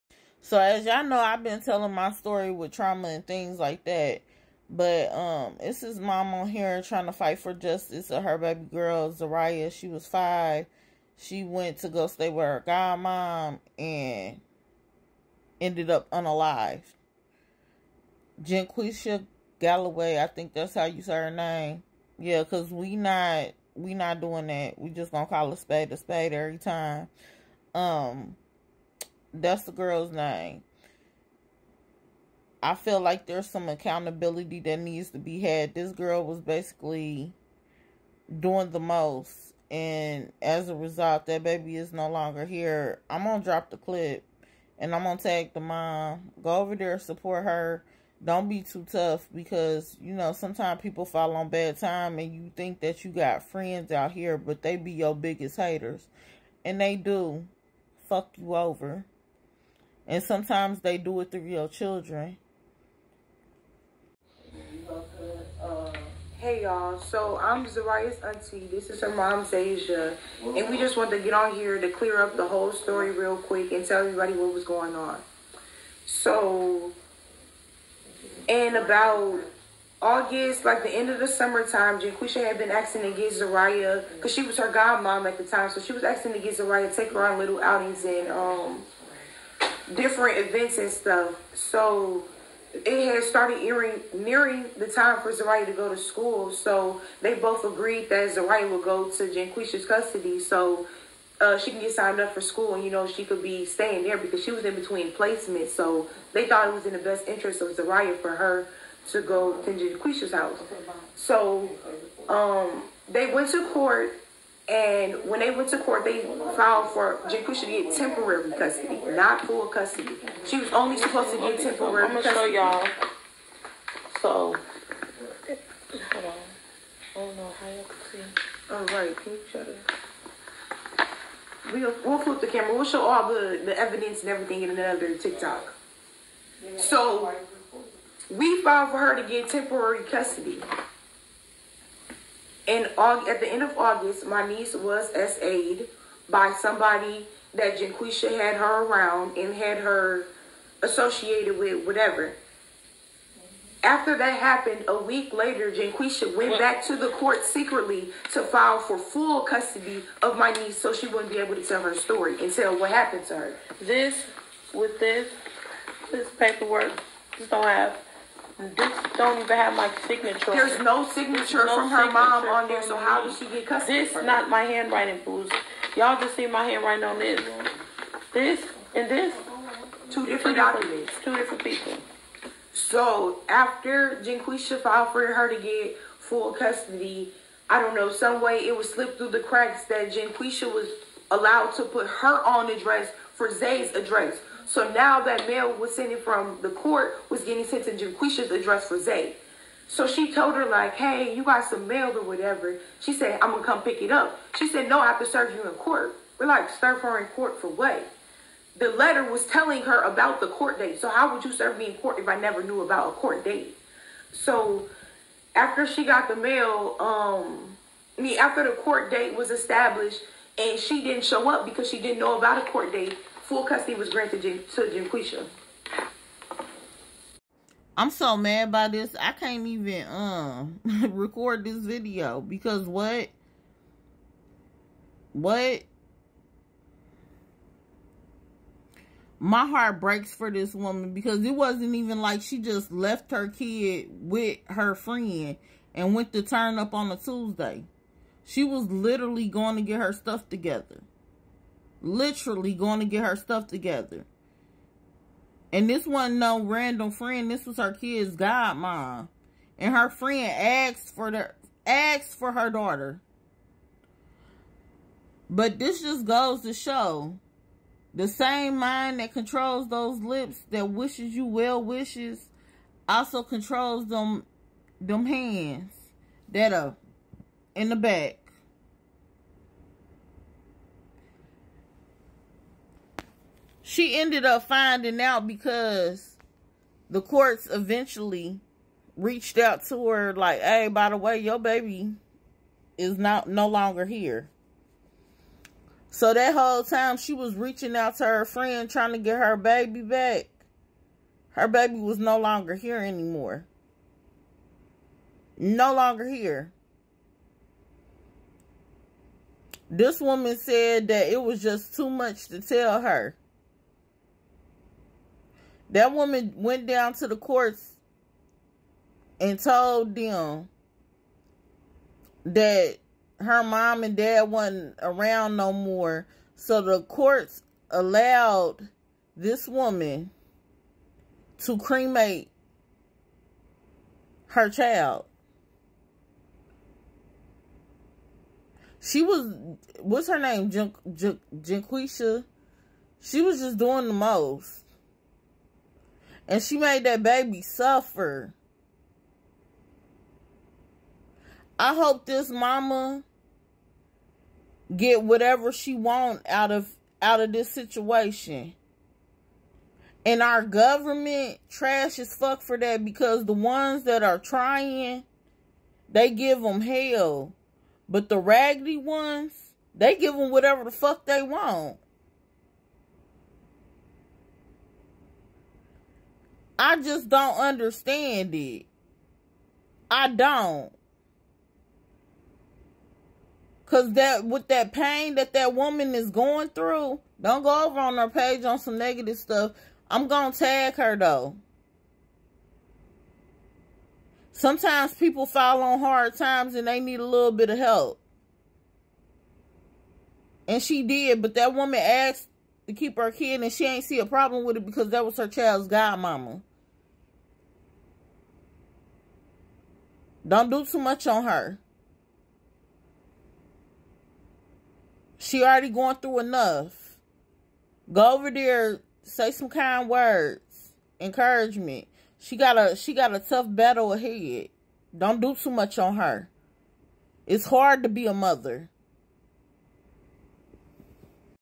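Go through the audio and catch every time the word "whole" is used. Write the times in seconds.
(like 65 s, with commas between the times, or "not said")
72 s, 296 s.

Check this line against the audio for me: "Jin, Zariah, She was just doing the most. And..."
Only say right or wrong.
wrong.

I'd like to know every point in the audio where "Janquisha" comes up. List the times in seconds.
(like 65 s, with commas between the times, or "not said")
99 s, 109 s, 147 s, 155 s, 224 s.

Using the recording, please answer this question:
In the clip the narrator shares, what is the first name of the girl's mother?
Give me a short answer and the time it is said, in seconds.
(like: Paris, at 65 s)
Asia, at 69 s.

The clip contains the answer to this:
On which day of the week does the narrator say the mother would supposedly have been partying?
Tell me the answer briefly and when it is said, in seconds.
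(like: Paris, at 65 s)
Tuesday, at 247 s.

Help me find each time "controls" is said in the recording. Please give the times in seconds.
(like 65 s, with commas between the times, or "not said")
269 s, 273 s.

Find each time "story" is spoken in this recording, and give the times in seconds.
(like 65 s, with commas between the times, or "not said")
2 s, 72 s, 161 s.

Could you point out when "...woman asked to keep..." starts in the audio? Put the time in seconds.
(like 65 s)
401 s.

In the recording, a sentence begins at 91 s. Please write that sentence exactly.
So it had started nearing, nearing the time for Zariah to go to school.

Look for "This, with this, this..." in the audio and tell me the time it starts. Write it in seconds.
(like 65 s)
163 s.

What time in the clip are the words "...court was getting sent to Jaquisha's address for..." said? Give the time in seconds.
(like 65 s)
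196 s.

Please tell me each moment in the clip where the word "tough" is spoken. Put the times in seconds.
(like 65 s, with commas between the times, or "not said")
48 s, 423 s.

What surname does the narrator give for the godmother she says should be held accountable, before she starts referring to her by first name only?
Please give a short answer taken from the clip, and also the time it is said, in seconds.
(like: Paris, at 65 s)
Galloway, at 19 s.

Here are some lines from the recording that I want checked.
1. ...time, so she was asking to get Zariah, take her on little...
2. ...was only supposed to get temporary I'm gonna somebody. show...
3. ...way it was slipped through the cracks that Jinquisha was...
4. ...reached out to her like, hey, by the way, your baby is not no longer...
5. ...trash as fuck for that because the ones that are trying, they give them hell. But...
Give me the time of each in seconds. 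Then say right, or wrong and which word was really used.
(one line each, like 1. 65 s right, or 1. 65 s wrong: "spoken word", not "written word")
1. 85 s right
2. 120 s wrong: "custody", not "somebody"
3. 188 s right
4. 289 s right
5. 361 s right.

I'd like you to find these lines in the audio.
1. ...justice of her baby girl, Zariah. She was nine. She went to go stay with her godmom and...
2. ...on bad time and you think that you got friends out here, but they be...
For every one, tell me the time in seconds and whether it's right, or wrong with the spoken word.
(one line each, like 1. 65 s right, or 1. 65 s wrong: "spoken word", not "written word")
1. 7 s wrong: "five", not "nine"
2. 51 s right.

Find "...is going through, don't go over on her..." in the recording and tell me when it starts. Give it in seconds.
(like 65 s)
386 s.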